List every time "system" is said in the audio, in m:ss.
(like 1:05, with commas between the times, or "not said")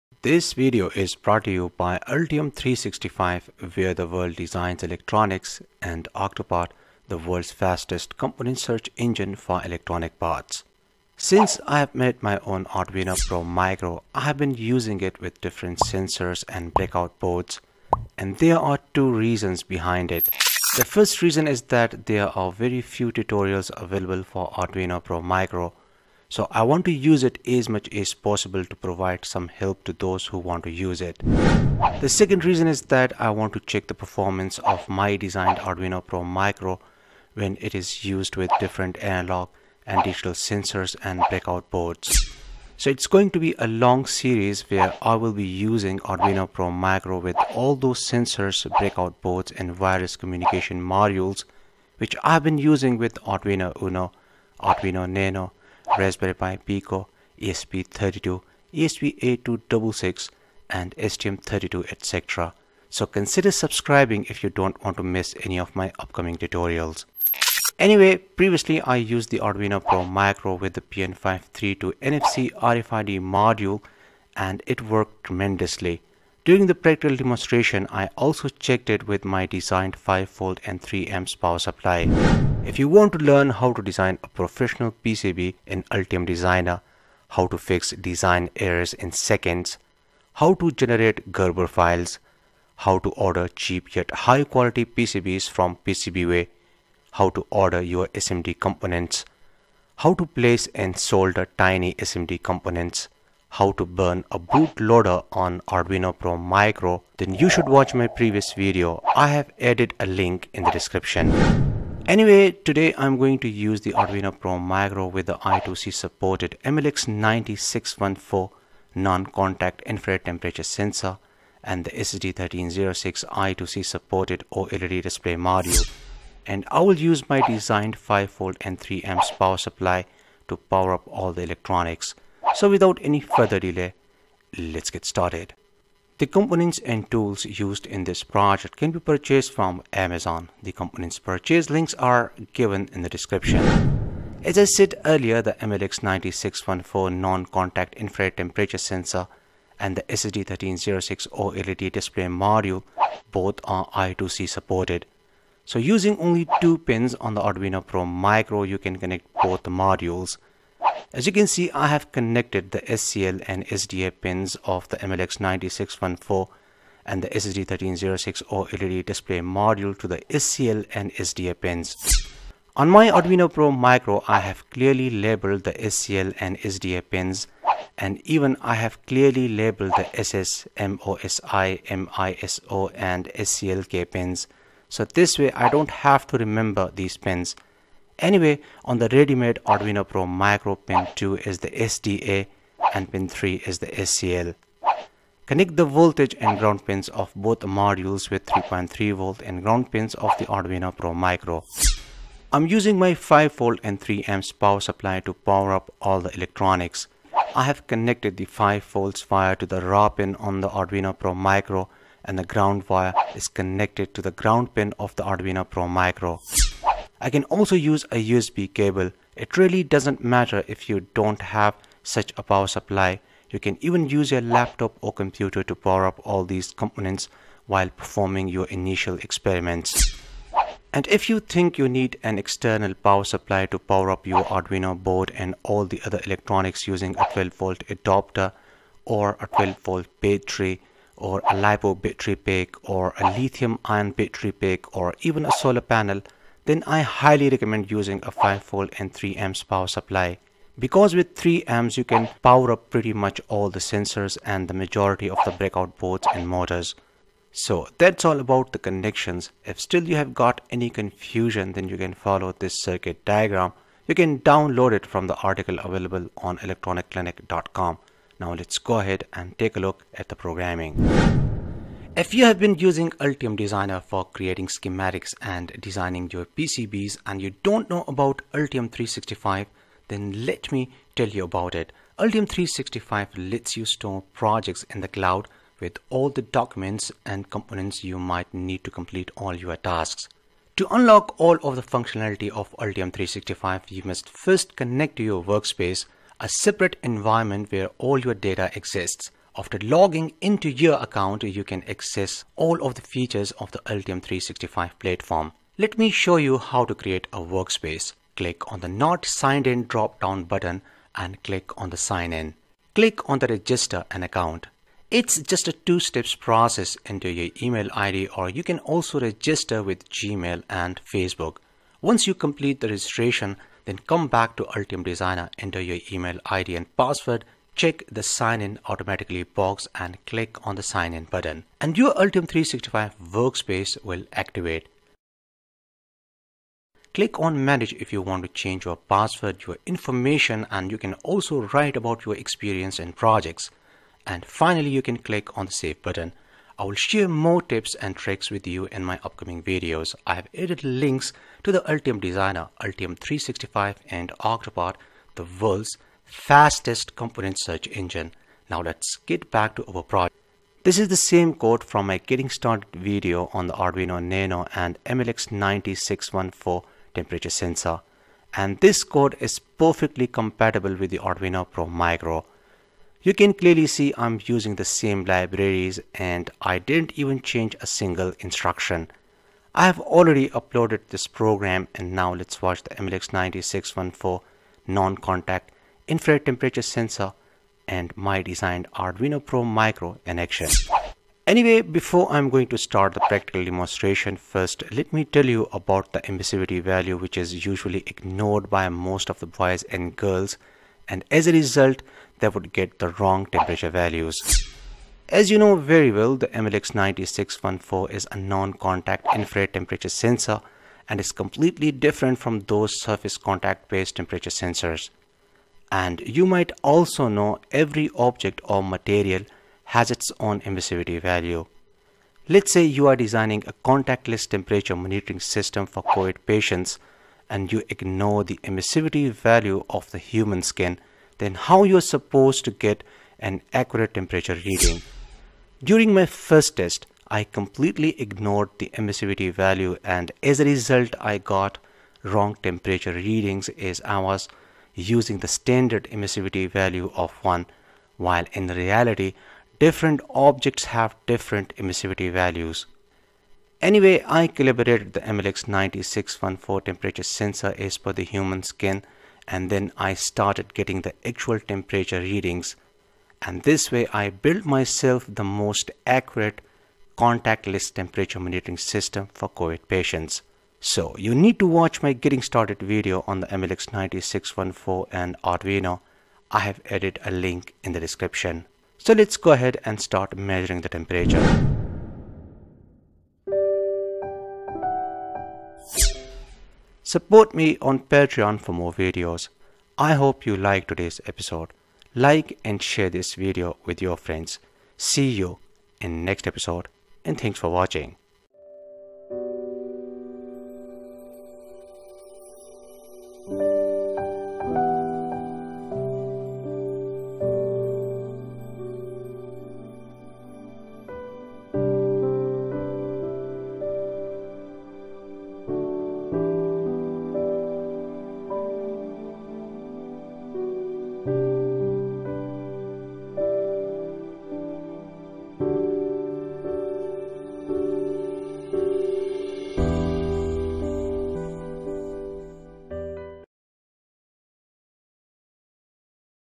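7:05, 7:48.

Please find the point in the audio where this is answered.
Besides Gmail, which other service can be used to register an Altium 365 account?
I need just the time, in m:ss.
5:21.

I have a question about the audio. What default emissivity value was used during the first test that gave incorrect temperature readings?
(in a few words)
1.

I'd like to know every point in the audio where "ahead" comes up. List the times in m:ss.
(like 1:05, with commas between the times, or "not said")
4:28, 7:59.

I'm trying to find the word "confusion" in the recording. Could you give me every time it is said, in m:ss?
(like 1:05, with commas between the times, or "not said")
4:20.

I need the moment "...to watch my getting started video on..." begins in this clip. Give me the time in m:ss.
7:51.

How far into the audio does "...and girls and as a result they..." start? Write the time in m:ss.
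6:39.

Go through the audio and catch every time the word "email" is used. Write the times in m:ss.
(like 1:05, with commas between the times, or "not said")
5:17, 5:26.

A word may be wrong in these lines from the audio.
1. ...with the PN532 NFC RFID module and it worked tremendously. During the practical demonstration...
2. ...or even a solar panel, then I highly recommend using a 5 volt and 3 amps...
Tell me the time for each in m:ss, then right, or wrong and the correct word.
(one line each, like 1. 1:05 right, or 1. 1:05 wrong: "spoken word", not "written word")
1. 1:10 right
2. 4:04 right.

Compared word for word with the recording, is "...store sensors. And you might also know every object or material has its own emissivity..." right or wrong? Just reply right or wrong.
wrong.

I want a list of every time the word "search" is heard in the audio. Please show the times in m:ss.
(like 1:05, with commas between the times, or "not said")
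0:08, 5:57.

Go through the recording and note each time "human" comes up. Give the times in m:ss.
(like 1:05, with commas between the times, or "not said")
7:10, 7:38.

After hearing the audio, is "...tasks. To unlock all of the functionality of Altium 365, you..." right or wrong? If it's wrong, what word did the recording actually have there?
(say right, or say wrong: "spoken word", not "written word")
right.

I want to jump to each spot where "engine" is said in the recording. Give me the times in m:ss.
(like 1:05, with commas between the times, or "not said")
0:08, 5:57.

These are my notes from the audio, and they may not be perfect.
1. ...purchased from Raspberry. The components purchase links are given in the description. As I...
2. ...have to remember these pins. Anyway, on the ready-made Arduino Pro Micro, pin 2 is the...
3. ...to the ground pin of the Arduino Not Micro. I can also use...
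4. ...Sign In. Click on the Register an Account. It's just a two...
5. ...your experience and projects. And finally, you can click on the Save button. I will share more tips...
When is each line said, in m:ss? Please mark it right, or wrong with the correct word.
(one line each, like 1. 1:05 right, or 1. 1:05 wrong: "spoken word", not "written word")
1. 2:18 wrong: "Amazon", not "Raspberry"
2. 3:05 right
3. 3:34 wrong: "Pro", not "Not"
4. 5:11 right
5. 5:42 right.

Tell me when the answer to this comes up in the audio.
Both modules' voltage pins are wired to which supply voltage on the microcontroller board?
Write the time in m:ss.
3:18.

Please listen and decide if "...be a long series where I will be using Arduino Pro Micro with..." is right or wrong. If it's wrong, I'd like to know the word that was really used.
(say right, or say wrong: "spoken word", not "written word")
right.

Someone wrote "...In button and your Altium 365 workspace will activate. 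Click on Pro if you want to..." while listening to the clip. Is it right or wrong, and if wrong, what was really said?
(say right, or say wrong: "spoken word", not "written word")
wrong: "Manage", not "Pro".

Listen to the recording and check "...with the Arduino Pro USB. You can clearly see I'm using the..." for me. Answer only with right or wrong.
wrong.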